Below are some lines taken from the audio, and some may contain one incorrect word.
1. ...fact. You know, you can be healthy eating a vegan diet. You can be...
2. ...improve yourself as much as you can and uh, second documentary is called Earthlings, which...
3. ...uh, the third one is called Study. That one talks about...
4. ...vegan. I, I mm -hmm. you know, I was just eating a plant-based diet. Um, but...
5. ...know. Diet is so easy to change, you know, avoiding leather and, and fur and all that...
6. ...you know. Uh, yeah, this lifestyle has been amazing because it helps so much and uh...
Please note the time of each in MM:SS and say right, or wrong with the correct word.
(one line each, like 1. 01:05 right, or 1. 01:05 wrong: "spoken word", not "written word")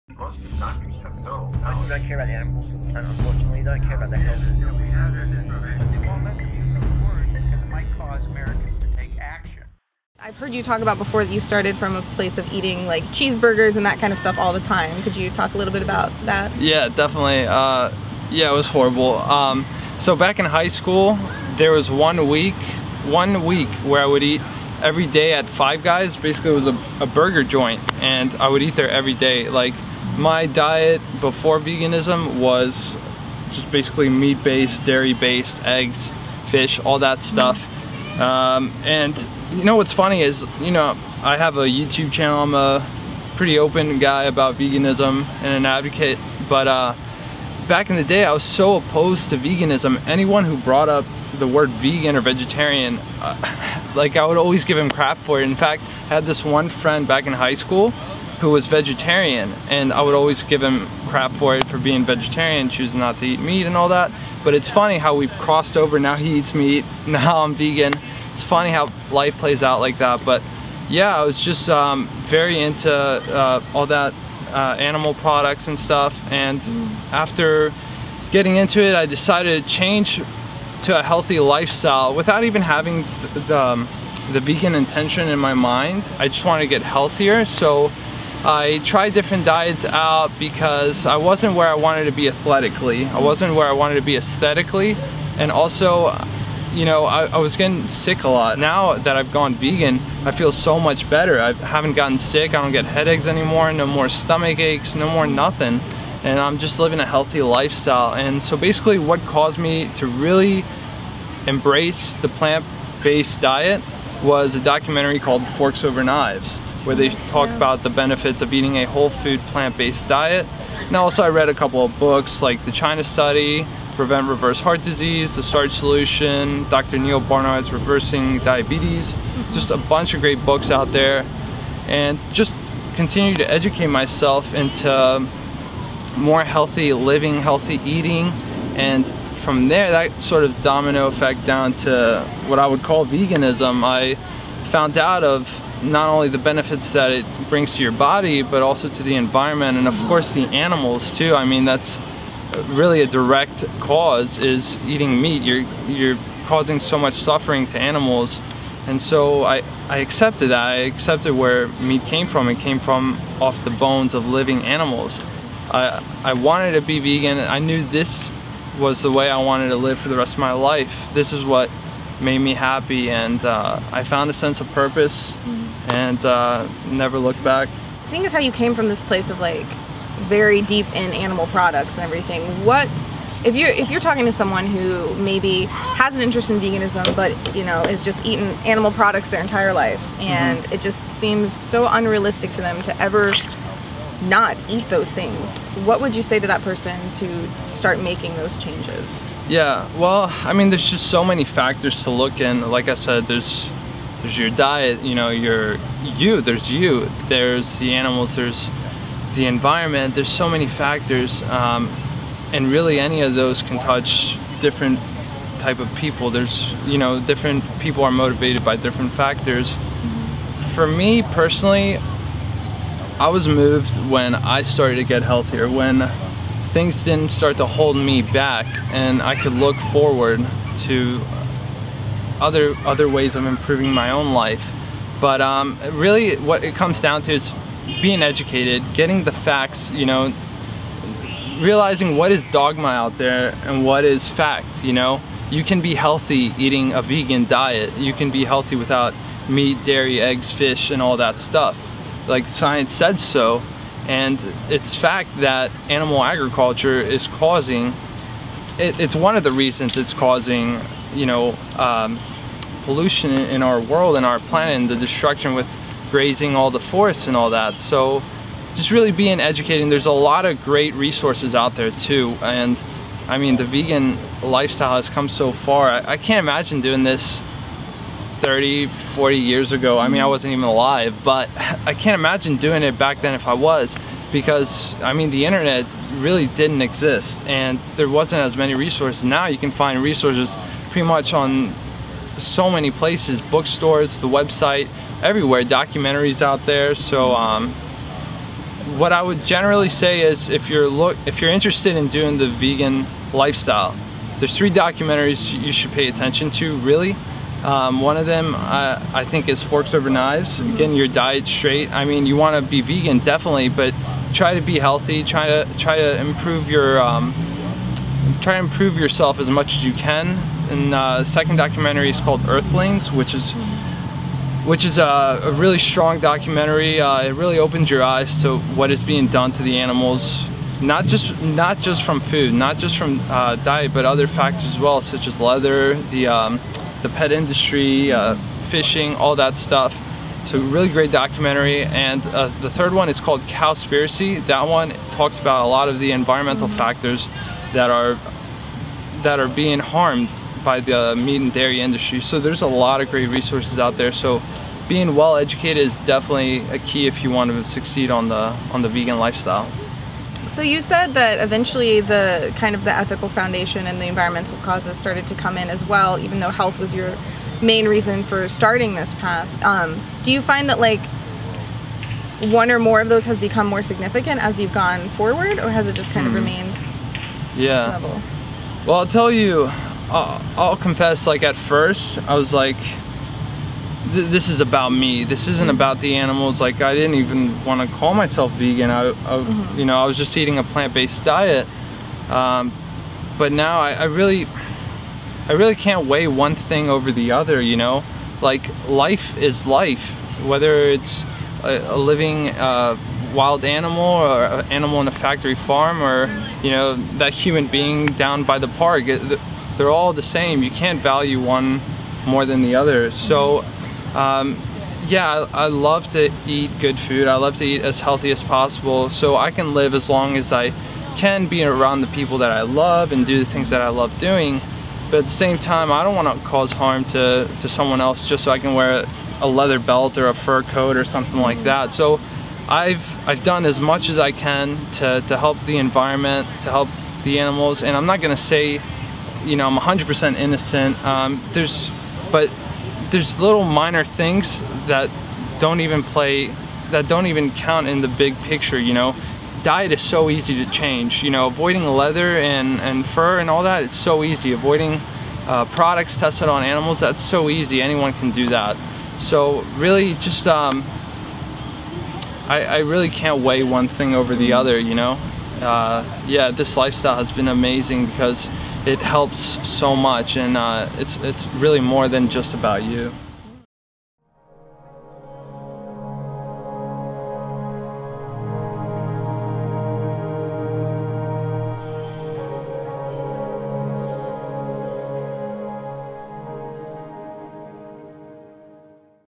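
1. 04:04 right
2. 05:18 right
3. 05:42 wrong: "Cowspiracy", not "Study"
4. 06:28 right
5. 07:28 right
6. 07:44 right.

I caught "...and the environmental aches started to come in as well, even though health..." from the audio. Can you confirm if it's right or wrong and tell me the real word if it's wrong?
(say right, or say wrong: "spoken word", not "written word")
wrong: "causes", not "aches".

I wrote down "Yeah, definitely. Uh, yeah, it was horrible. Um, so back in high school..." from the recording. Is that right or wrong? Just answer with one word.
right.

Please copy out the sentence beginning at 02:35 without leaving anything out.
You're, you're causing so much suffering to animals.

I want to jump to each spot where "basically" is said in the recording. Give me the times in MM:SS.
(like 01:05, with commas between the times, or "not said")
00:26, 00:33, 01:48.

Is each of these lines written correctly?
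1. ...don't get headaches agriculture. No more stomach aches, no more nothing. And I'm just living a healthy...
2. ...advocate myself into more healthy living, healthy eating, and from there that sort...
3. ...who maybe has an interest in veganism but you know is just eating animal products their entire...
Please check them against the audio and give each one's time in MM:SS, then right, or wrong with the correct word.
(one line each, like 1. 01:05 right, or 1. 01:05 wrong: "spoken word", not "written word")
1. 01:42 wrong: "anymore", not "agriculture"
2. 02:13 wrong: "educate", not "advocate"
3. 03:04 right.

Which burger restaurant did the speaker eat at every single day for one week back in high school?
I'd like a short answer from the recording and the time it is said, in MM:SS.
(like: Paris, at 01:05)
Five Guys, at 00:25.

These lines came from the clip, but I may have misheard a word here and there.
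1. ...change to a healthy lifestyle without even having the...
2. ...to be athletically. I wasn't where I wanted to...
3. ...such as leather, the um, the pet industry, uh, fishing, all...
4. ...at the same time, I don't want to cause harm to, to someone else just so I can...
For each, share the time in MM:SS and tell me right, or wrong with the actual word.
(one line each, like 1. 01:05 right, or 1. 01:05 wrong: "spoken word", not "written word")
1. 01:19 right
2. 01:32 right
3. 05:35 right
4. 07:05 right.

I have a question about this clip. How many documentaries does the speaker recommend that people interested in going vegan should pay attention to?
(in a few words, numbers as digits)
3.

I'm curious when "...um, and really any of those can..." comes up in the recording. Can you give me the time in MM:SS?
03:31.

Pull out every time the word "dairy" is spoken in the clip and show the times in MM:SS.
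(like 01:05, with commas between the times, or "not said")
00:34, 04:09, 05:51.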